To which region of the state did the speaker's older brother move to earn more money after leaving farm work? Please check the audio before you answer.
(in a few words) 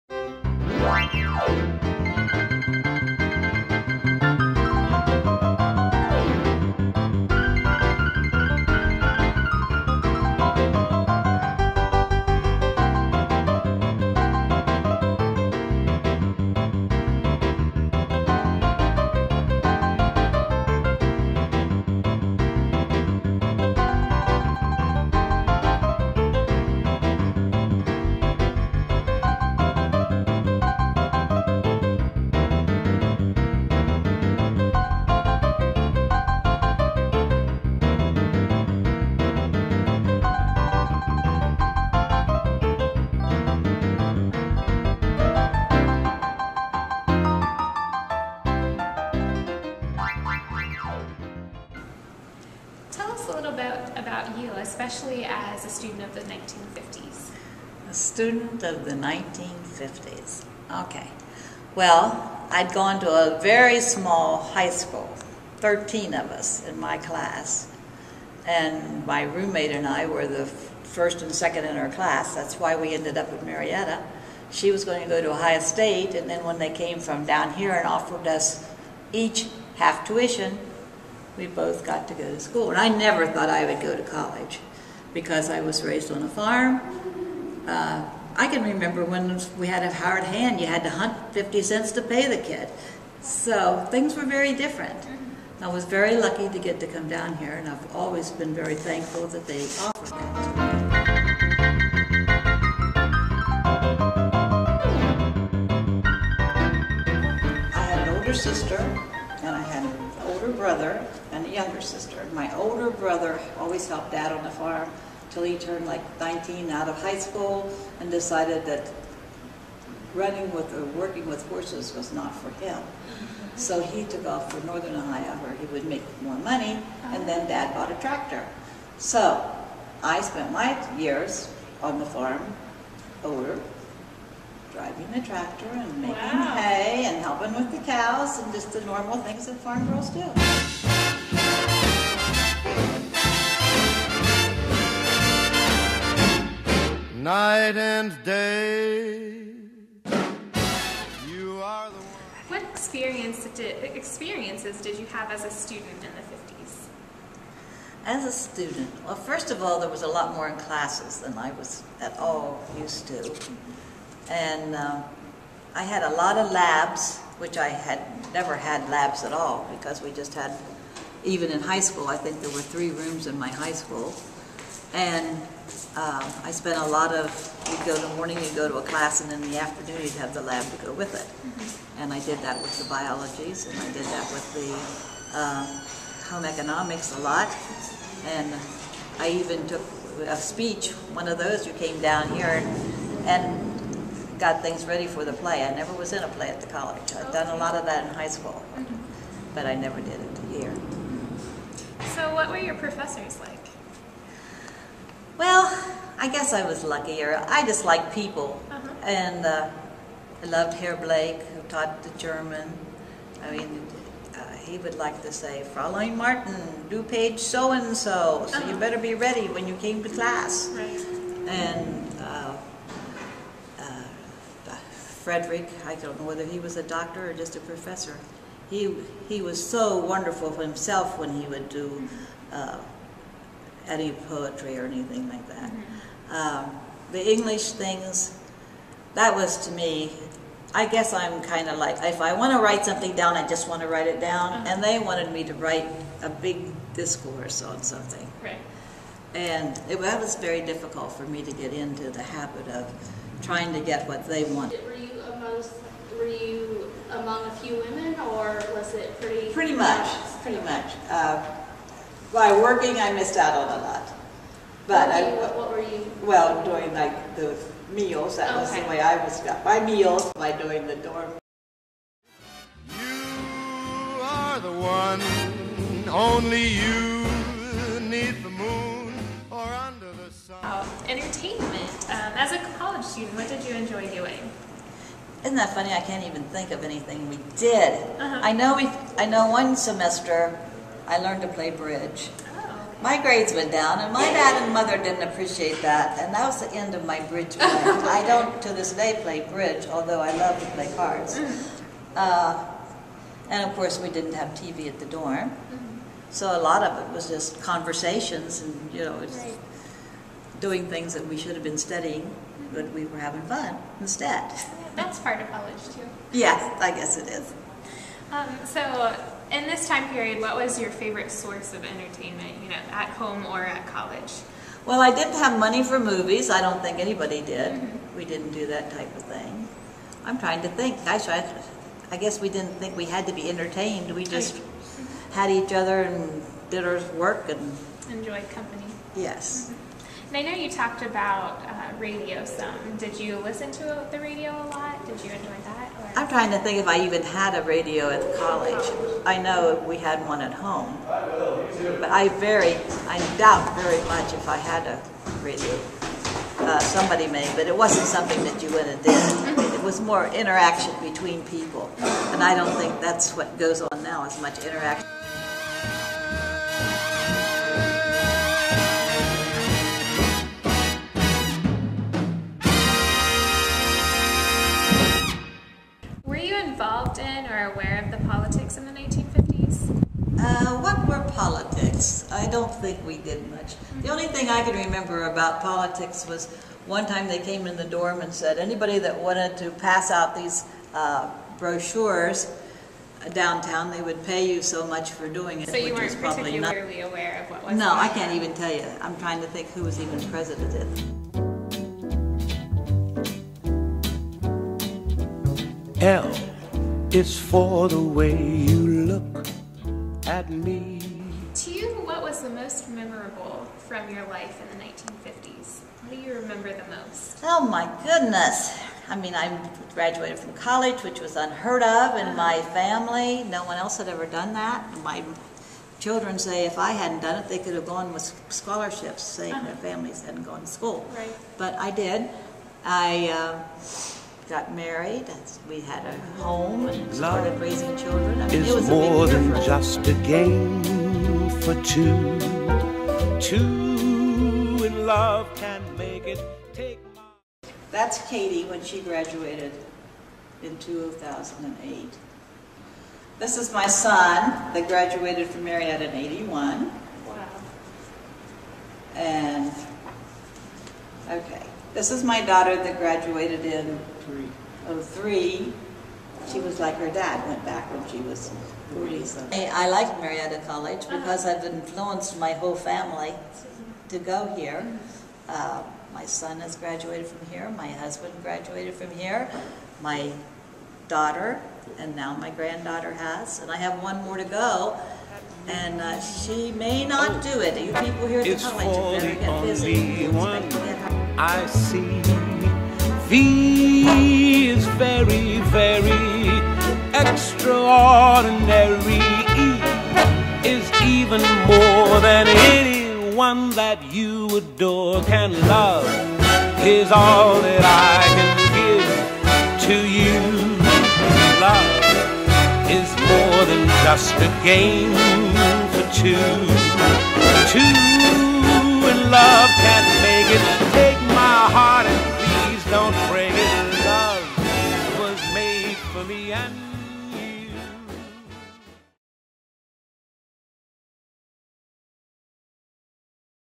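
Northern Ohio.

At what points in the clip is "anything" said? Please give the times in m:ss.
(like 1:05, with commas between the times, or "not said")
3:54, 4:46.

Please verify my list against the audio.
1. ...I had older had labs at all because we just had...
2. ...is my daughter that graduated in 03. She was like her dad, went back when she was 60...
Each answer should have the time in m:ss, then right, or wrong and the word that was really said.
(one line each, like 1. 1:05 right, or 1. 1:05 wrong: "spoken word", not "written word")
1. 2:47 wrong: "never", not "older"
2. 7:42 wrong: "40", not "60".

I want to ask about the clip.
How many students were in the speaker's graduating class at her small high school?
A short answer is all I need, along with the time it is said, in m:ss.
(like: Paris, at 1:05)
13, at 1:05.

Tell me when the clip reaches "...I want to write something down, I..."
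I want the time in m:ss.
4:02.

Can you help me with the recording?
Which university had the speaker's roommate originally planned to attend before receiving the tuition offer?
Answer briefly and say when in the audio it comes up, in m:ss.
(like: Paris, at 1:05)
Ohio State, at 1:15.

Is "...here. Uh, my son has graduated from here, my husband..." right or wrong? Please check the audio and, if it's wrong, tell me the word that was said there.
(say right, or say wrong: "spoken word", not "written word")
right.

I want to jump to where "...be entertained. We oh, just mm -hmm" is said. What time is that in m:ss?
5:33.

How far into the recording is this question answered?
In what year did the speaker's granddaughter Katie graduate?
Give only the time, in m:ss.
7:30.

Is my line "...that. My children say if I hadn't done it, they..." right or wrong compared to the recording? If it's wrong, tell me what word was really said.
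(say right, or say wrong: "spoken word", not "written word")
right.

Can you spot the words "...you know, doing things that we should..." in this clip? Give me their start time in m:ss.
5:08.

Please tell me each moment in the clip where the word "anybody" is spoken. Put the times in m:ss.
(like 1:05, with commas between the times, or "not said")
5:26, 6:28.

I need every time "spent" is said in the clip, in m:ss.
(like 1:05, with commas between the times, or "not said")
2:10, 2:56.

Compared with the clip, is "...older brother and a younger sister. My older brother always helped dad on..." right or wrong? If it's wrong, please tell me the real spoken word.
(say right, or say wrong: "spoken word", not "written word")
right.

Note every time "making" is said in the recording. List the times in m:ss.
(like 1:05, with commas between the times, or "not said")
2:16.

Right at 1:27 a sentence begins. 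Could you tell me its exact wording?
Uh, I can remember when we had a hard hand, you had to hunt 50 cents to pay the kid.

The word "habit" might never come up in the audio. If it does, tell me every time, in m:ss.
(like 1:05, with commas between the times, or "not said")
4:12.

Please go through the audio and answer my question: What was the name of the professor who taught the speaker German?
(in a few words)
Herr Blake.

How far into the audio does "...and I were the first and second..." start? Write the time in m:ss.
1:09.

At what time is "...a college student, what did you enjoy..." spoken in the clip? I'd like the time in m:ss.
4:42.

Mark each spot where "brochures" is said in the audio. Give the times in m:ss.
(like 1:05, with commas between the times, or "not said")
6:31.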